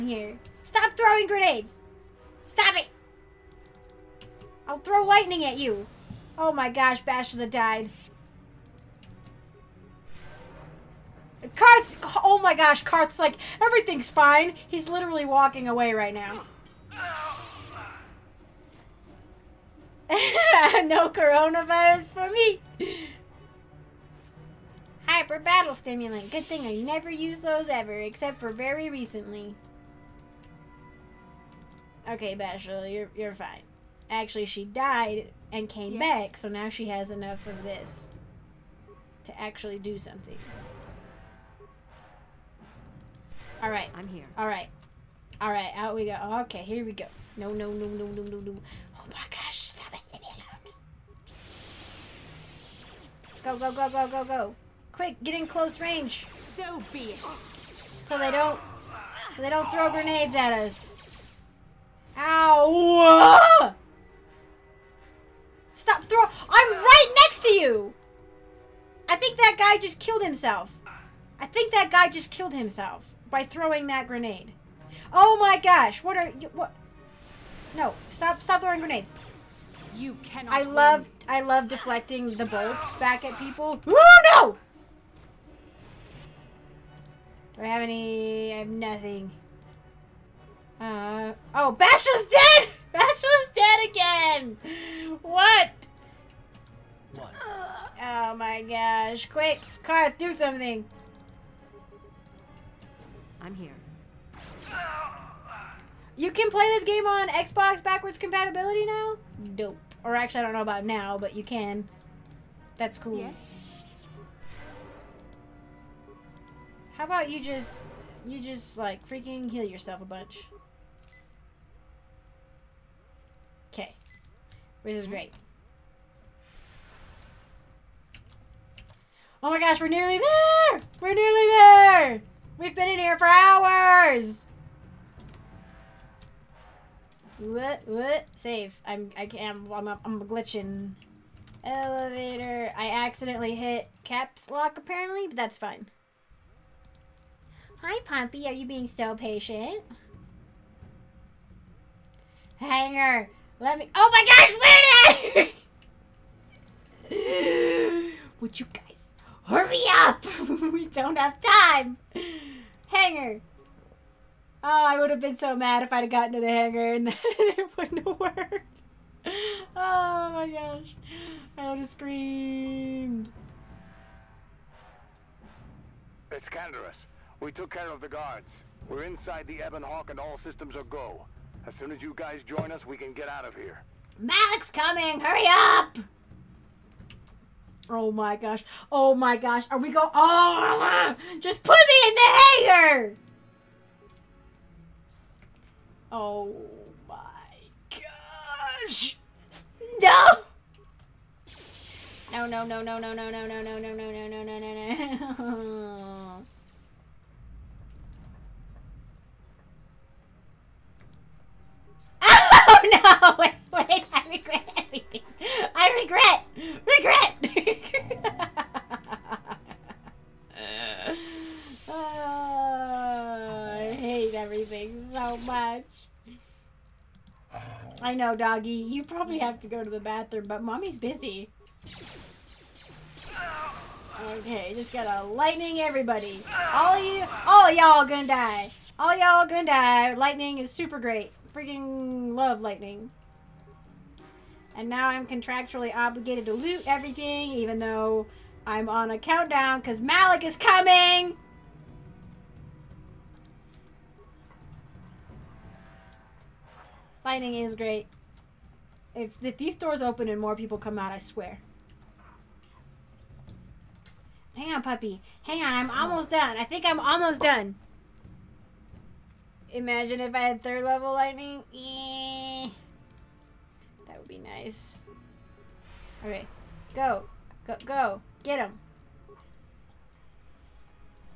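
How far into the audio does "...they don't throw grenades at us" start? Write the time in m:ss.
0:59.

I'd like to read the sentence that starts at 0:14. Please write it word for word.
He's literally walking away right now.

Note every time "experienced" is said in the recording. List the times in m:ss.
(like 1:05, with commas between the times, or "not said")
not said.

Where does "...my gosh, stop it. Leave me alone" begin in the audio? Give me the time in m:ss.
0:49.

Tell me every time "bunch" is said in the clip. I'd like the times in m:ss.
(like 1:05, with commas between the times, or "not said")
2:00.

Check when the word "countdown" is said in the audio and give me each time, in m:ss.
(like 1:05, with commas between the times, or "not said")
4:09.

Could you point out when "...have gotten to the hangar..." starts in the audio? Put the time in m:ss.
2:46.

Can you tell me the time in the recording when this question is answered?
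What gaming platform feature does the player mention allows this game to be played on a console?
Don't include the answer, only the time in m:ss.
1:47.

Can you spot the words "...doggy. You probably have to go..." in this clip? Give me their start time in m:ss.
3:48.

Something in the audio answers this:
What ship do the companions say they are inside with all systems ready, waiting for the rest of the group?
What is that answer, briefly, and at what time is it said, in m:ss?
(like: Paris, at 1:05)
Ebon Hawk, at 2:59.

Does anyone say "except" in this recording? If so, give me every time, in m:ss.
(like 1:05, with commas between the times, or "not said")
0:27.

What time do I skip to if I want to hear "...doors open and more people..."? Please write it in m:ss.
4:19.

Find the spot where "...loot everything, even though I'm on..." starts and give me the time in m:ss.
4:06.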